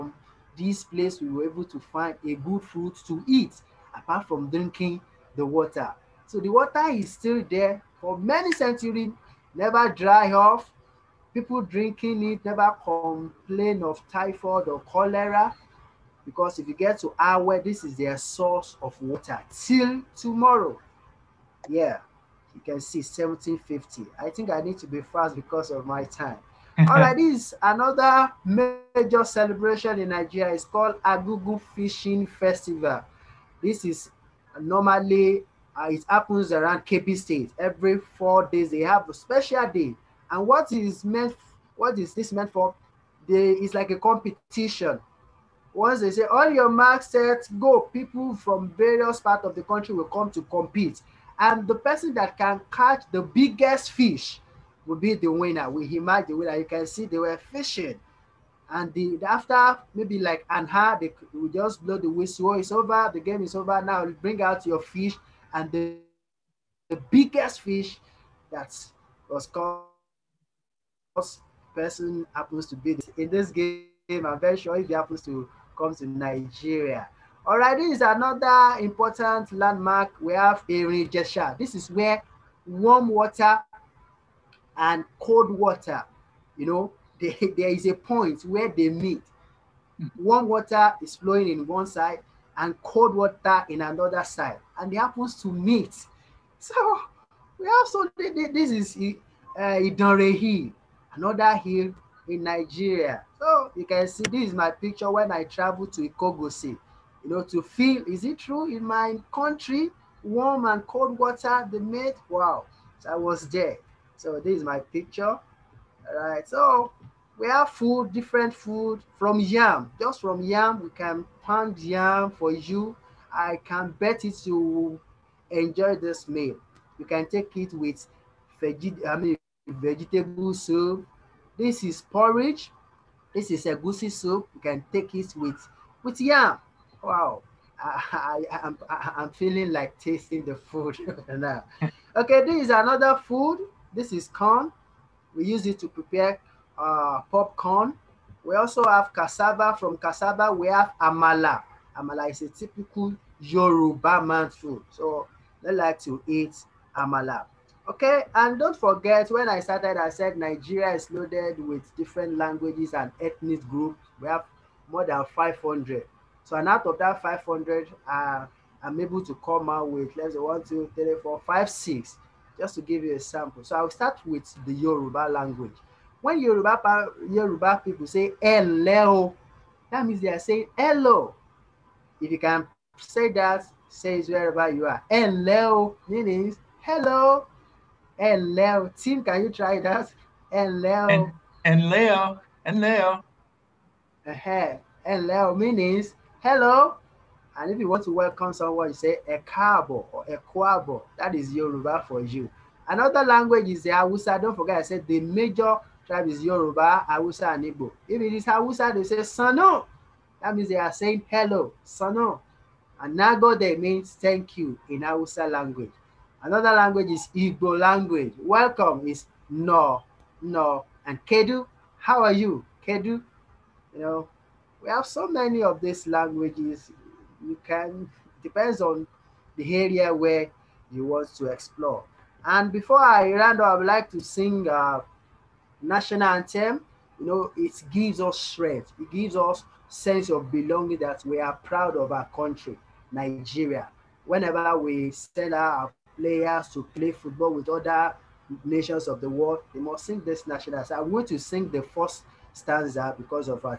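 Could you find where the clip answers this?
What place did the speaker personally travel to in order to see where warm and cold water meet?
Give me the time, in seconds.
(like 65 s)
106 s.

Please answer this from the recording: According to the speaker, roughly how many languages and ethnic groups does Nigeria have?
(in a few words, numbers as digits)
More than 500.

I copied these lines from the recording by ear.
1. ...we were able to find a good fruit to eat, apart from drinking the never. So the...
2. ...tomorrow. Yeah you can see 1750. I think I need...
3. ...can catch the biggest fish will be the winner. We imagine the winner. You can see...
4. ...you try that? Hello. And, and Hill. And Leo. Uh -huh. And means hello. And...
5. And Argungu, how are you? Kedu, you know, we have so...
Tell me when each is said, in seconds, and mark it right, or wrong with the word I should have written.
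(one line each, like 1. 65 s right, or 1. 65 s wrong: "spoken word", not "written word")
1. 1 s wrong: "water", not "never"
2. 20 s right
3. 52 s right
4. 189 s wrong: "Leo", not "Hill"
5. 221 s wrong: "Kedu", not "Argungu".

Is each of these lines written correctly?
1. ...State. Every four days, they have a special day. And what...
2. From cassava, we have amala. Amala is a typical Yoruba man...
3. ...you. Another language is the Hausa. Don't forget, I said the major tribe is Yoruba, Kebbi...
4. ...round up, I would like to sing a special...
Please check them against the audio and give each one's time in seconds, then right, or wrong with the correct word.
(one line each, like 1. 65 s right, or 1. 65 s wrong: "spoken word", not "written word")
1. 37 s right
2. 149 s right
3. 202 s wrong: "Hausa", not "Kebbi"
4. 233 s wrong: "national", not "special".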